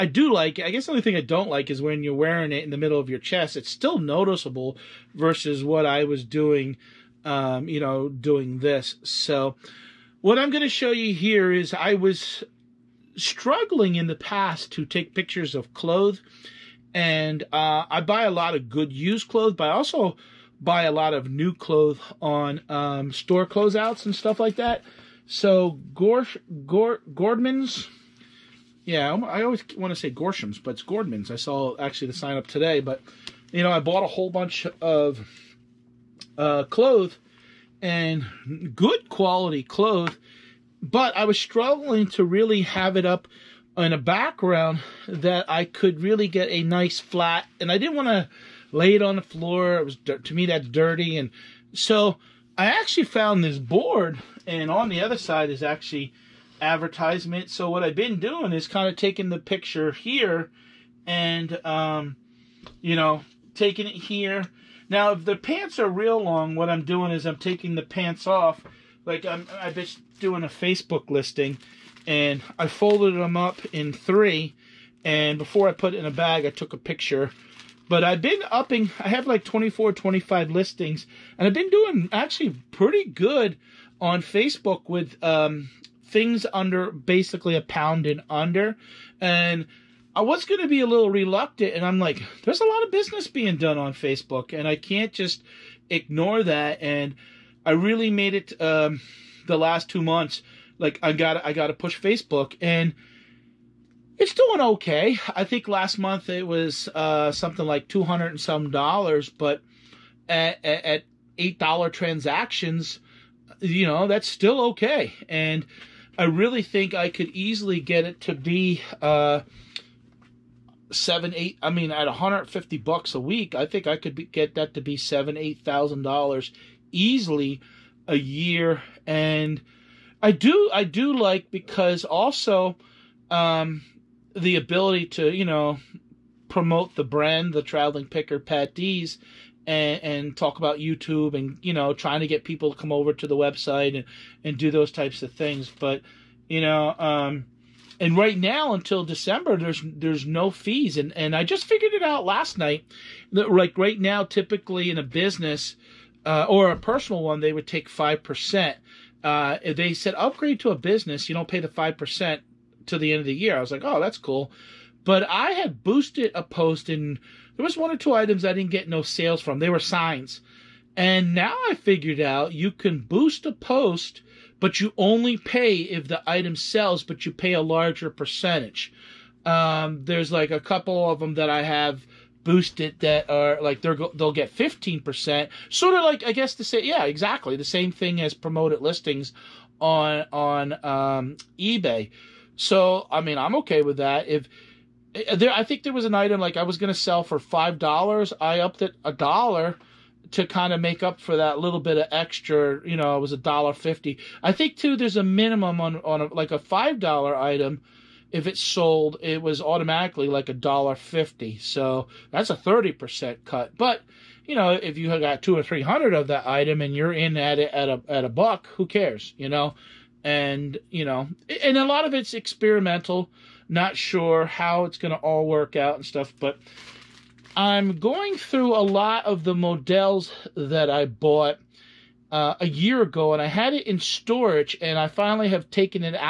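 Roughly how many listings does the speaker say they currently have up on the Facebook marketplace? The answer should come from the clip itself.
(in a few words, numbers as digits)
24, 25.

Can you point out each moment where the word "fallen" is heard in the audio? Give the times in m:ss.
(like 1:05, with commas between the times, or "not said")
not said.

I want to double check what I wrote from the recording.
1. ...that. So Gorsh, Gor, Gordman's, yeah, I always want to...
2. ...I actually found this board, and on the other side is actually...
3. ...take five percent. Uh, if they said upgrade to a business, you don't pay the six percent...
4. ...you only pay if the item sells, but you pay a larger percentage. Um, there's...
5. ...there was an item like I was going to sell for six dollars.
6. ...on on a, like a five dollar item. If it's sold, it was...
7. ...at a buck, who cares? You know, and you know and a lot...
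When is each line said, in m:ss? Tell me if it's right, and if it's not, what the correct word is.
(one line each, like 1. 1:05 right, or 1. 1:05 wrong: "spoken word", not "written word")
1. 0:24 right
2. 0:52 right
3. 2:37 wrong: "five", not "six"
4. 2:54 right
5. 3:15 wrong: "five", not "six"
6. 3:25 right
7. 3:38 right.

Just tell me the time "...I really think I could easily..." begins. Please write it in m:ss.
1:56.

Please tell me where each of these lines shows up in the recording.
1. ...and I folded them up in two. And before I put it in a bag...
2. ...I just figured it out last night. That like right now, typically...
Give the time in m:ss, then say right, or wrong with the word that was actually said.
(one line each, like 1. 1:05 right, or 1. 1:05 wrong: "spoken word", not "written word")
1. 1:12 wrong: "three", not "two"
2. 2:31 right.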